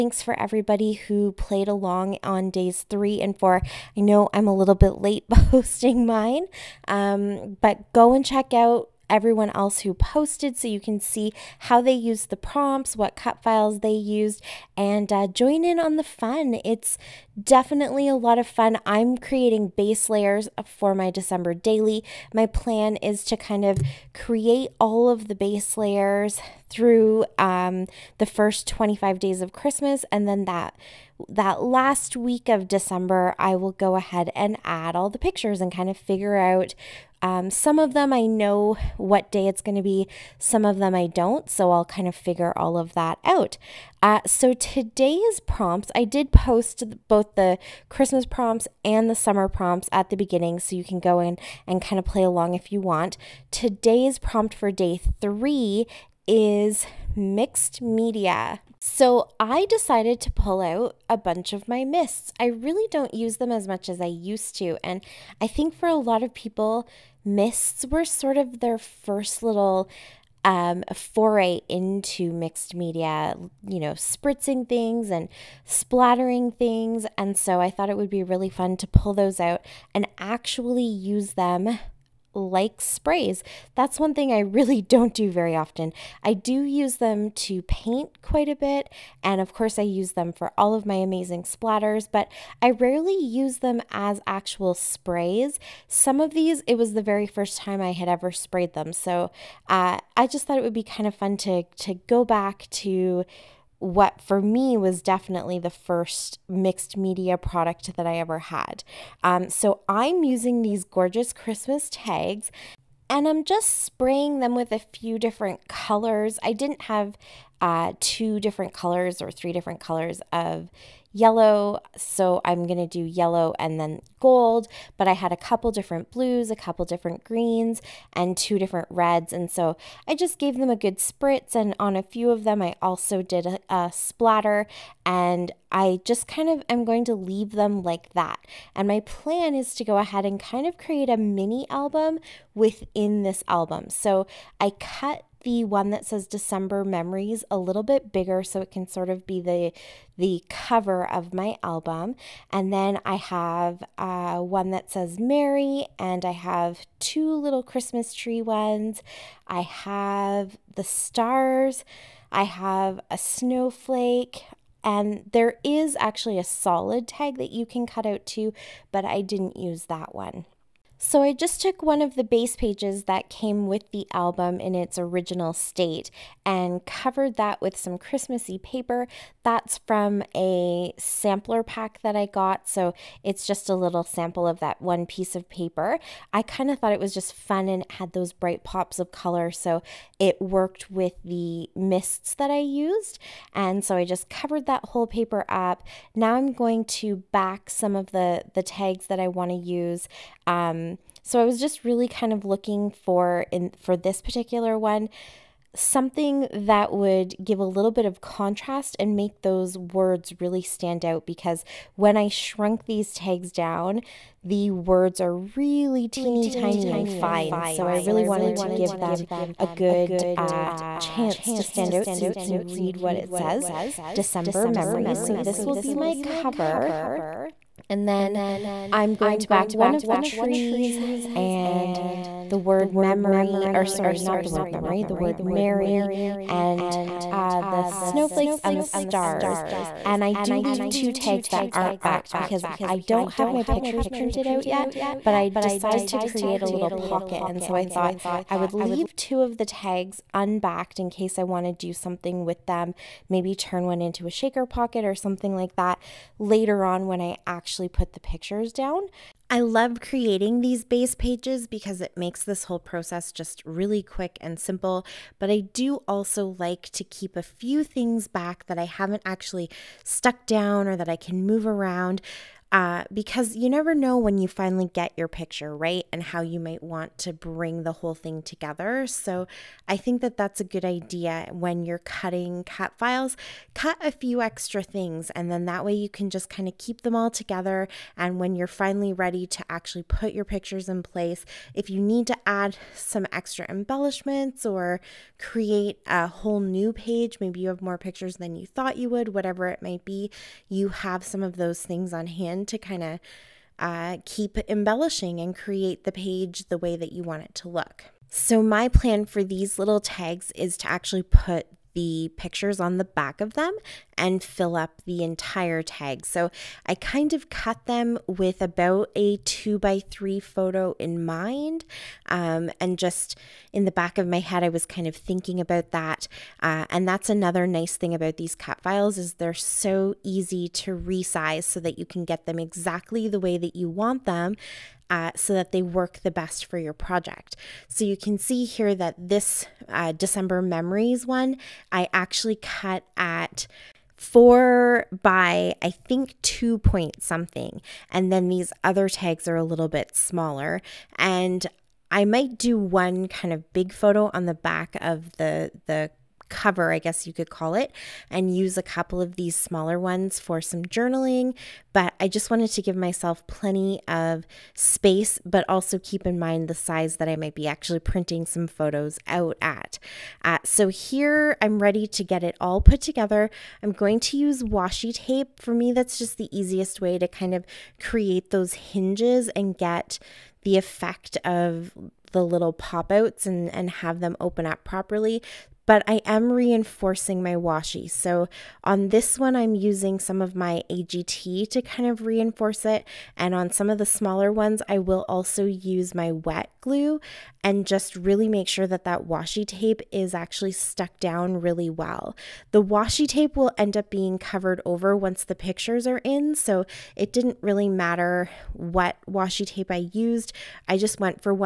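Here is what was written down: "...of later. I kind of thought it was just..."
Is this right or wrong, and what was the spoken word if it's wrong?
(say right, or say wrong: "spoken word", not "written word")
wrong: "paper", not "later".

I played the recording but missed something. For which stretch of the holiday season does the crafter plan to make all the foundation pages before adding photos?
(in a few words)
First 25 days.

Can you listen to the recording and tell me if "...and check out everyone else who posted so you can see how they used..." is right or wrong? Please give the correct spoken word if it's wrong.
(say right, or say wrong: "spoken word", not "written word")
right.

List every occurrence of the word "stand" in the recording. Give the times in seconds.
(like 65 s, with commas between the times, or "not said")
210 s, 221 s.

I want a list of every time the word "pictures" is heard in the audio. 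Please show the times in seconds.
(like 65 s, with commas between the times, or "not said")
35 s, 243 s, 258 s, 275 s, 290 s, 297 s, 312 s, 405 s.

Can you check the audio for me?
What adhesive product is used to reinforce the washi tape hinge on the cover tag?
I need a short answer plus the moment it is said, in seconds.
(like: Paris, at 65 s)
AGT, at 390 s.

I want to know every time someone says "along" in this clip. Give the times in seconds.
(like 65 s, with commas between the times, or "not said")
1 s, 52 s.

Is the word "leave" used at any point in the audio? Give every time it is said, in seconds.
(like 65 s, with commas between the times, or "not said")
137 s, 240 s, 248 s.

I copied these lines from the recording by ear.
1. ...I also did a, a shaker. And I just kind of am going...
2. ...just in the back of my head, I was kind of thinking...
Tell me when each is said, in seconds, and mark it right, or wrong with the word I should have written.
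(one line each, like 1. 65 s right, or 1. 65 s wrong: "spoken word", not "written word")
1. 132 s wrong: "splatter", not "shaker"
2. 322 s right.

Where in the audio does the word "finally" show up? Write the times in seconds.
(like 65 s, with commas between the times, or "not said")
274 s, 288 s.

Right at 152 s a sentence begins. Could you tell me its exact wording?
And then I have uh, one that says Mary, and I have two little Christmas tree ones.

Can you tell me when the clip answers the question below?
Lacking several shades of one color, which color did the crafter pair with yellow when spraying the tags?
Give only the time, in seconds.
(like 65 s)
124 s.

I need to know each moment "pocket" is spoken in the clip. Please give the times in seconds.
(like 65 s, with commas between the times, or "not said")
246 s, 254 s.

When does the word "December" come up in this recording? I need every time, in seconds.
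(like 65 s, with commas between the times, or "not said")
21 s, 32 s, 146 s, 224 s, 340 s.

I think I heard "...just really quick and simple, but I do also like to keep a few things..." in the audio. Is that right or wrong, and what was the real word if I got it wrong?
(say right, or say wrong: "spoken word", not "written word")
right.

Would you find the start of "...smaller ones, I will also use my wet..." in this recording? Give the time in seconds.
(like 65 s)
394 s.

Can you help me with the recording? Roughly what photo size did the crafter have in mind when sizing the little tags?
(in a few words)
2 by 3.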